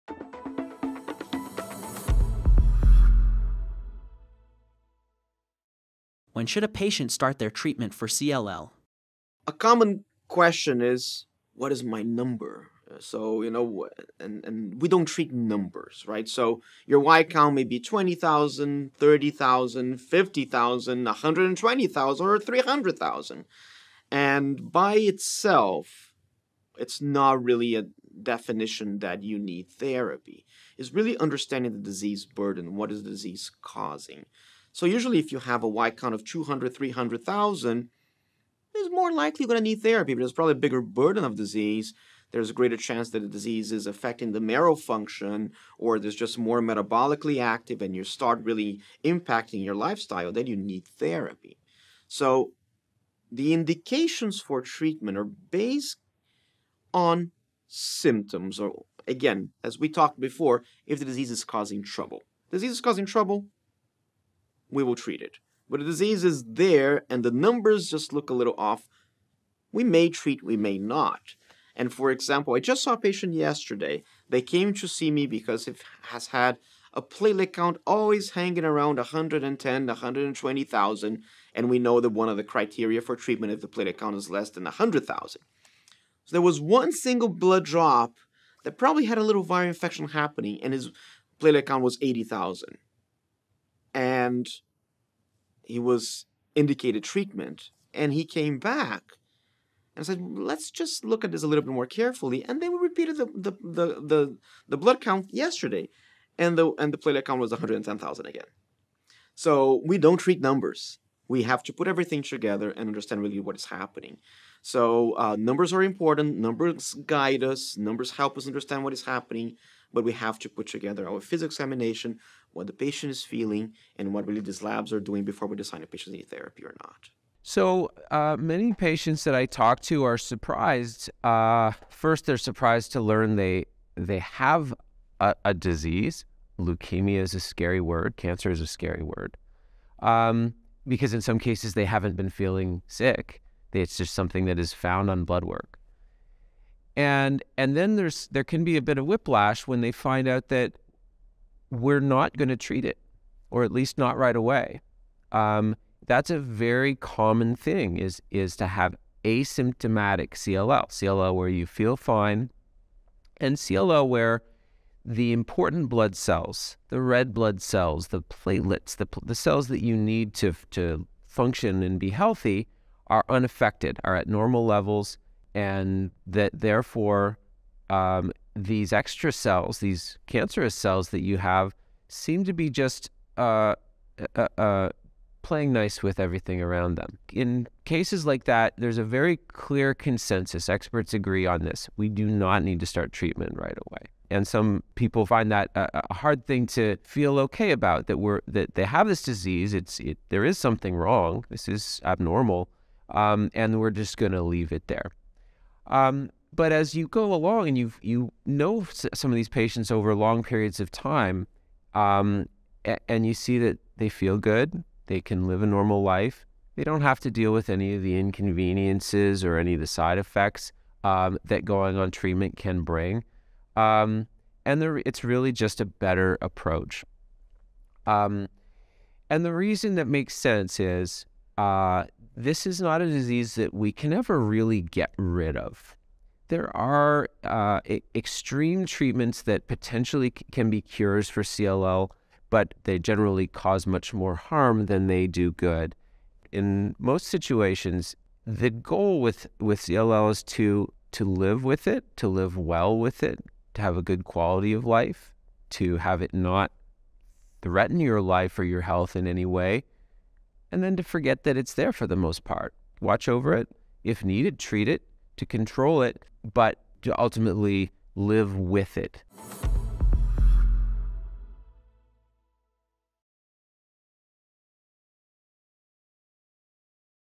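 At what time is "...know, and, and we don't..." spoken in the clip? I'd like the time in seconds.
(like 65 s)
13 s.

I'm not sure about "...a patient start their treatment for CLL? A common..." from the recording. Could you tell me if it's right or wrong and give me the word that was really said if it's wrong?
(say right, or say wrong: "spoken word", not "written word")
right.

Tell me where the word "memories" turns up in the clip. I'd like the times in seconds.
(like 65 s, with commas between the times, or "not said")
not said.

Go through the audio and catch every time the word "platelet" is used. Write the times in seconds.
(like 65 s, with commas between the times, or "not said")
77 s, 83 s, 91 s, 107 s, 168 s.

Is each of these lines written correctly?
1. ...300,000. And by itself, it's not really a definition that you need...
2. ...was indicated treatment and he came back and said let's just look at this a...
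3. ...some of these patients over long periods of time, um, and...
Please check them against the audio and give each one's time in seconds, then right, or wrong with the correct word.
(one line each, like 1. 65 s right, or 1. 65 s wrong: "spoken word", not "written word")
1. 22 s right
2. 95 s right
3. 209 s right.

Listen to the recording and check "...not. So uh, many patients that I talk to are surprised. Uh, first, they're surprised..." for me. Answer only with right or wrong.
right.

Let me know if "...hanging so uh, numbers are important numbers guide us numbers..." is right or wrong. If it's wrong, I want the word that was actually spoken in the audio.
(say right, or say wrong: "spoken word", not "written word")
wrong: "happening", not "hanging".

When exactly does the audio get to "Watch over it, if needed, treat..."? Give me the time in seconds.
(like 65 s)
263 s.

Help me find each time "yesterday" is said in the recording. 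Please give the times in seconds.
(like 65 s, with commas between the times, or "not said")
73 s, 105 s.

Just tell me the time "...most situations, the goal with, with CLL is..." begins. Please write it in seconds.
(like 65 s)
246 s.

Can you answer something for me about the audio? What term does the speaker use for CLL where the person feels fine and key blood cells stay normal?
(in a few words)
asymptomatic CLL.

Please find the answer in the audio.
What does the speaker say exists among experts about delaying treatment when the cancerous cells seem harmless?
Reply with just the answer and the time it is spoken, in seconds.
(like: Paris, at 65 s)
a very clear consensus, at 189 s.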